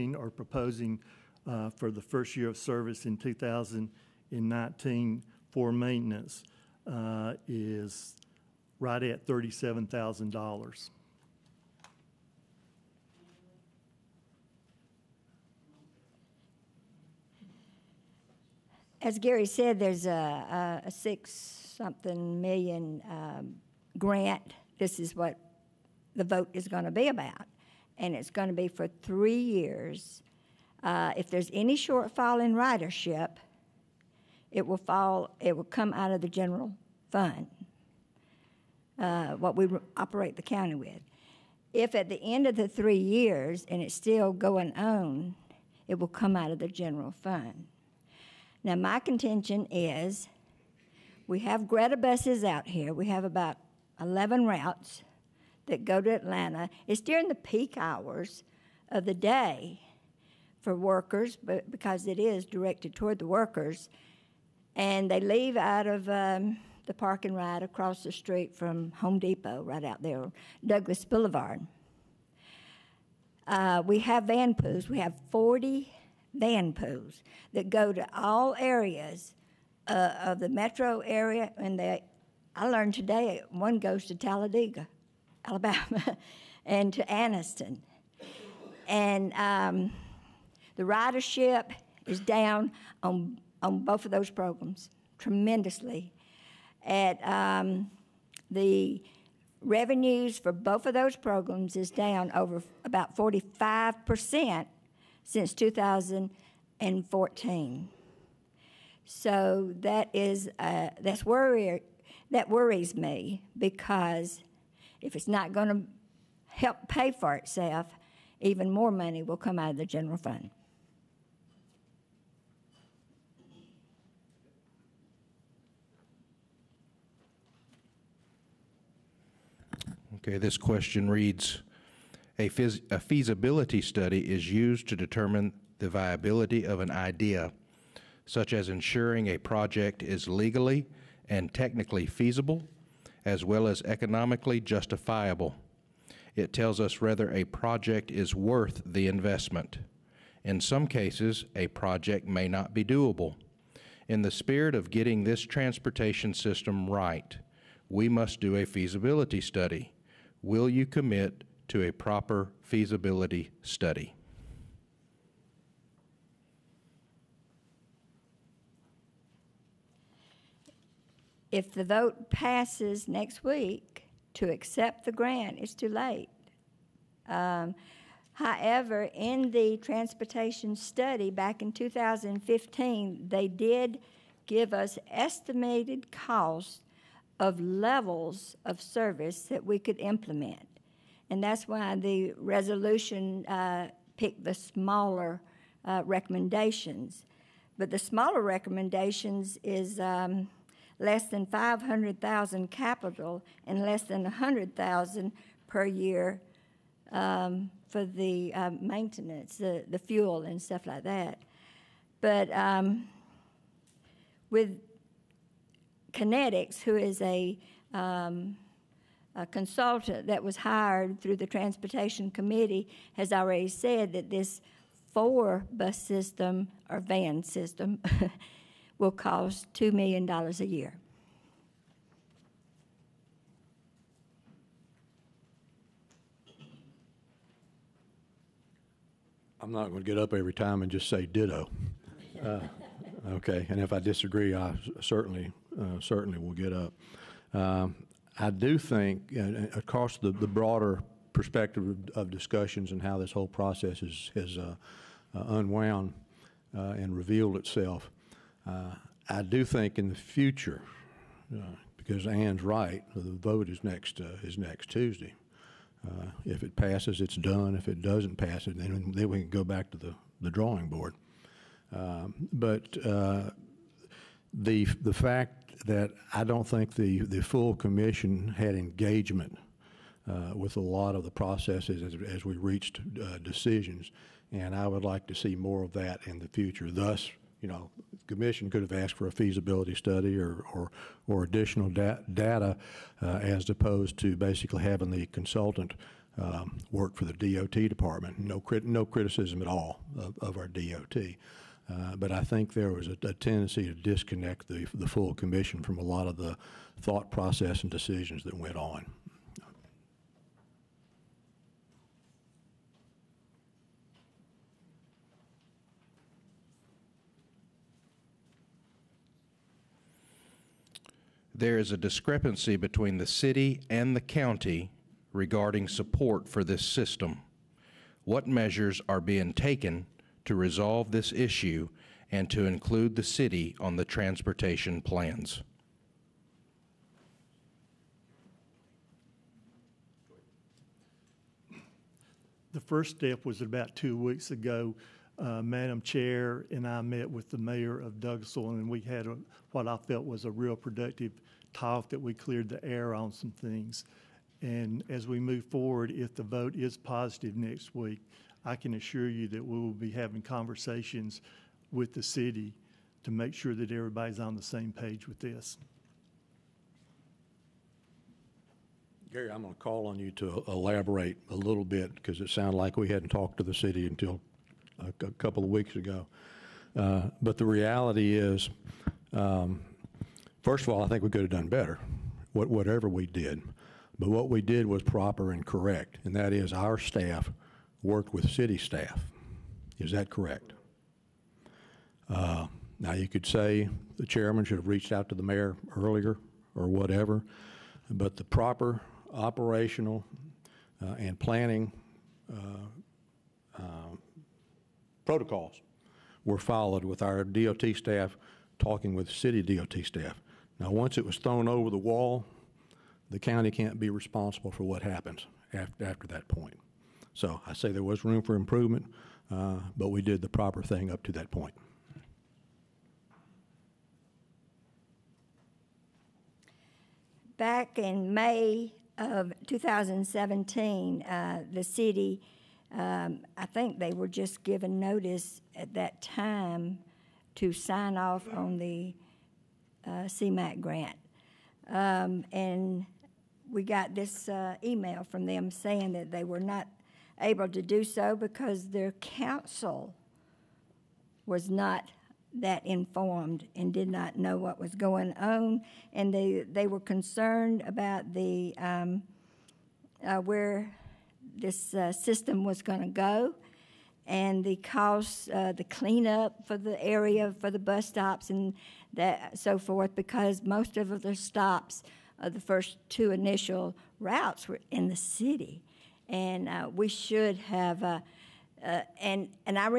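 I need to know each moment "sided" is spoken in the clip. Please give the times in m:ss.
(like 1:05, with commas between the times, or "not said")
not said.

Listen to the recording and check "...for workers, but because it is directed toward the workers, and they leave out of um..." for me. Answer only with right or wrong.
right.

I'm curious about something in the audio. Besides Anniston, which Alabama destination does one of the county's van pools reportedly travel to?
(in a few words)
Talladega.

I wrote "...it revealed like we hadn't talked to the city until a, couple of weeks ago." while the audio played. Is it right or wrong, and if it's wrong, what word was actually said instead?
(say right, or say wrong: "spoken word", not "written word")
wrong: "sounded", not "revealed".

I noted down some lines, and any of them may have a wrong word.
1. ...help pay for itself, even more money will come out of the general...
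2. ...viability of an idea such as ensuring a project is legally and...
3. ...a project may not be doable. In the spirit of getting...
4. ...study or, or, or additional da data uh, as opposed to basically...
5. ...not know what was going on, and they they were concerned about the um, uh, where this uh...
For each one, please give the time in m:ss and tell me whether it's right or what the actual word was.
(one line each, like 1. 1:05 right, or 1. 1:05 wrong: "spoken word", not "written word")
1. 1:56 right
2. 2:15 right
3. 2:31 right
4. 4:49 right
5. 7:34 right.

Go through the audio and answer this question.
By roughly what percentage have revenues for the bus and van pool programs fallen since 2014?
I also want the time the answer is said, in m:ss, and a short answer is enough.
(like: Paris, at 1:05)
45%, at 1:43.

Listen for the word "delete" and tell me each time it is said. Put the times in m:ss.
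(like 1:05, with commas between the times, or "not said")
not said.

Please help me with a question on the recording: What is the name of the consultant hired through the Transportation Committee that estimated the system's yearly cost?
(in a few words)
Connetics.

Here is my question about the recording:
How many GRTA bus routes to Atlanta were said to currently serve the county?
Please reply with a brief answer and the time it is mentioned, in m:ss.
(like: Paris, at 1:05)
11, at 0:53.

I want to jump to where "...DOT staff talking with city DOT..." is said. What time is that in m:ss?
6:47.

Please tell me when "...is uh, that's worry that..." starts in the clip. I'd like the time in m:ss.
1:50.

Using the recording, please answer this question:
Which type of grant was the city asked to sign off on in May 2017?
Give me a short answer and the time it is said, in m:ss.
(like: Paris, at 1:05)
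CMAQ grant, at 7:20.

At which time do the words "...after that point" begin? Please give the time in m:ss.
6:56.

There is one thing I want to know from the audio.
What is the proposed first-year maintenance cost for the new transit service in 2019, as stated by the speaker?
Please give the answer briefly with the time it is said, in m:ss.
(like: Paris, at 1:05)
$37,000, at 0:09.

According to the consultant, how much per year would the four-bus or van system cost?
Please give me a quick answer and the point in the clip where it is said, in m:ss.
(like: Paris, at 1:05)
$2 million, at 3:49.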